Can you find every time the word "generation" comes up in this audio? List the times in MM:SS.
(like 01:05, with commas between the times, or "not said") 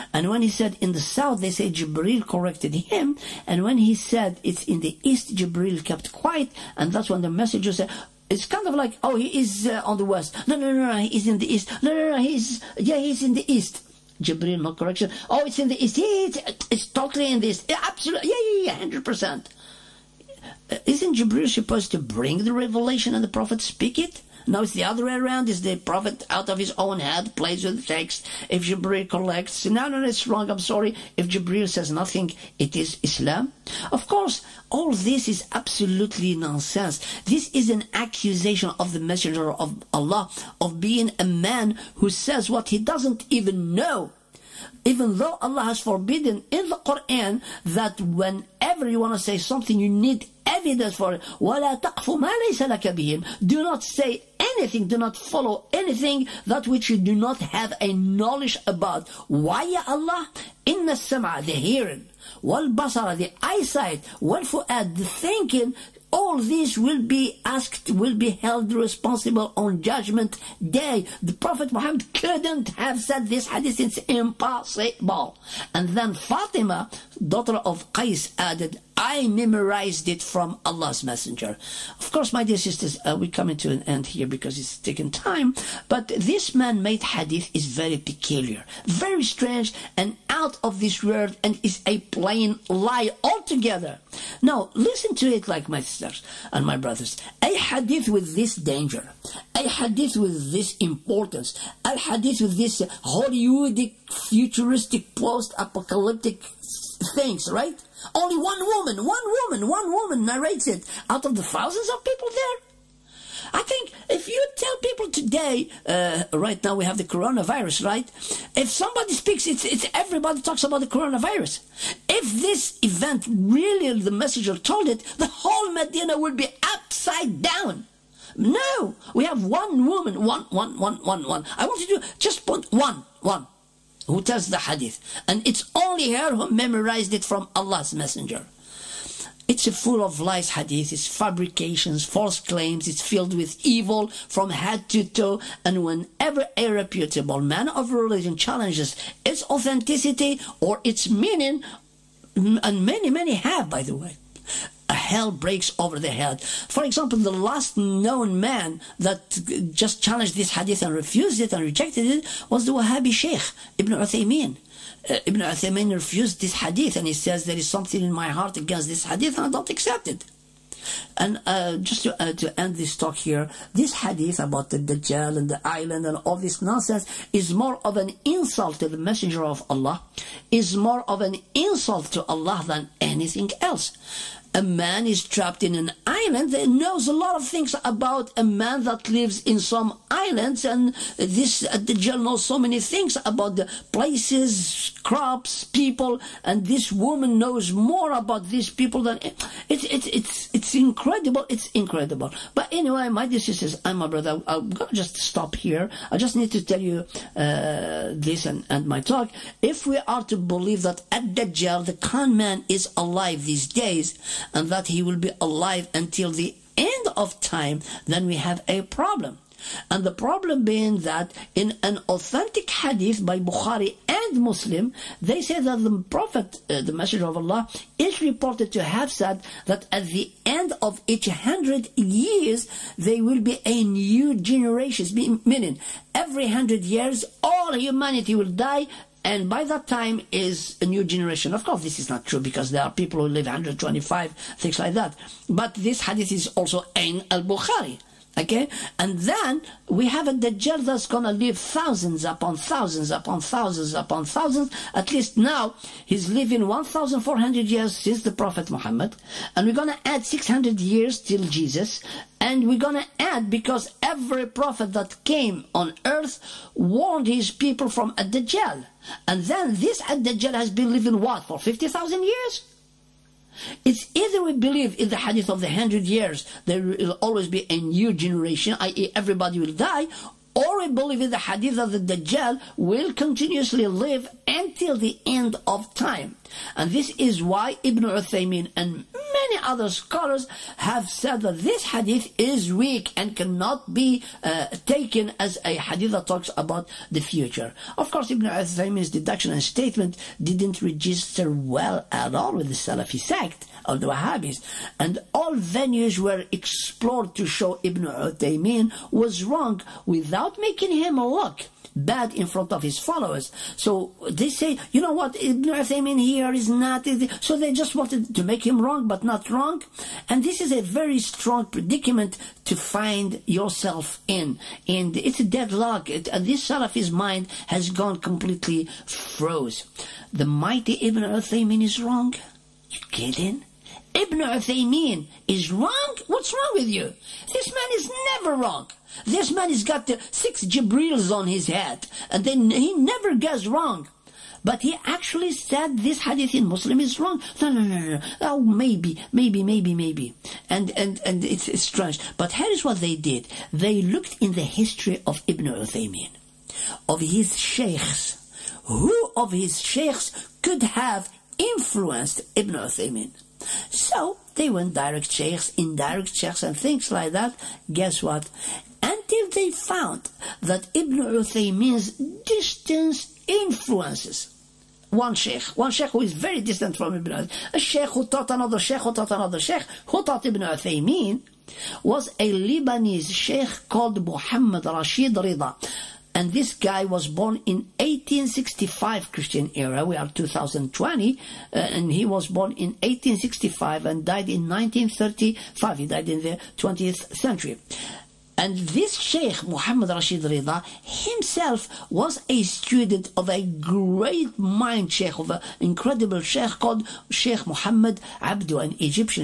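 03:54, 04:01, 04:38.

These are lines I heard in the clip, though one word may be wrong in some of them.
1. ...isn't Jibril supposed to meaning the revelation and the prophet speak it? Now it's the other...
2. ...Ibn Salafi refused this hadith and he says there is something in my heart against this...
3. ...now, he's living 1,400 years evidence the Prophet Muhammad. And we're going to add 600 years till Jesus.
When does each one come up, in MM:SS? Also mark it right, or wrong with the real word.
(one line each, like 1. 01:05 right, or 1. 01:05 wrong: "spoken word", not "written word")
1. 00:20 wrong: "bring", not "meaning"
2. 02:45 wrong: "Uthaymeen", not "Salafi"
3. 04:15 wrong: "since", not "evidence".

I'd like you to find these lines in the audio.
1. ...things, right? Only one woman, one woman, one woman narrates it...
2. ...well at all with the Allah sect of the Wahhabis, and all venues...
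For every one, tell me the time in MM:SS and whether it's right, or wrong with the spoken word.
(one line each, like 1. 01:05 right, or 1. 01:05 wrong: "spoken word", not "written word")
1. 01:47 right
2. 05:01 wrong: "Salafi", not "Allah".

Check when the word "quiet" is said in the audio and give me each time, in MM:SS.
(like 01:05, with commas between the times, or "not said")
00:06.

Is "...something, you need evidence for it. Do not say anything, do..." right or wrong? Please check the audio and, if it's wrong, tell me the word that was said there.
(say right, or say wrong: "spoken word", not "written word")
right.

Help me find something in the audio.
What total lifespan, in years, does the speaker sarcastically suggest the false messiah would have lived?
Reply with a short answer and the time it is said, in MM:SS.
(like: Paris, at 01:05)
50,000 years, at 04:31.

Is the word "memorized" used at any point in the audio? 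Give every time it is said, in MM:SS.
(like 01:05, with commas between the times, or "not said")
01:19, 02:16.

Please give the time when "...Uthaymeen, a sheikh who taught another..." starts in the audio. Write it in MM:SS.
06:17.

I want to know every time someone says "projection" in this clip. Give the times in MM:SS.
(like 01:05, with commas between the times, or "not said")
not said.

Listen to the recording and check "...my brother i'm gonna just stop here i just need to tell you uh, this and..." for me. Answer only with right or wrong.
right.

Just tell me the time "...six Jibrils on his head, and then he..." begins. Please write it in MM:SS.
05:40.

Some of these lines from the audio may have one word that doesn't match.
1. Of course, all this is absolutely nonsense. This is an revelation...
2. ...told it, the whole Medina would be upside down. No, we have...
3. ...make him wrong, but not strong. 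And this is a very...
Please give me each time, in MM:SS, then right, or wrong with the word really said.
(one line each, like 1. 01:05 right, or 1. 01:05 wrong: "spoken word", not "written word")
1. 00:33 wrong: "accusation", not "revelation"
2. 02:04 right
3. 05:18 wrong: "wrong", not "strong".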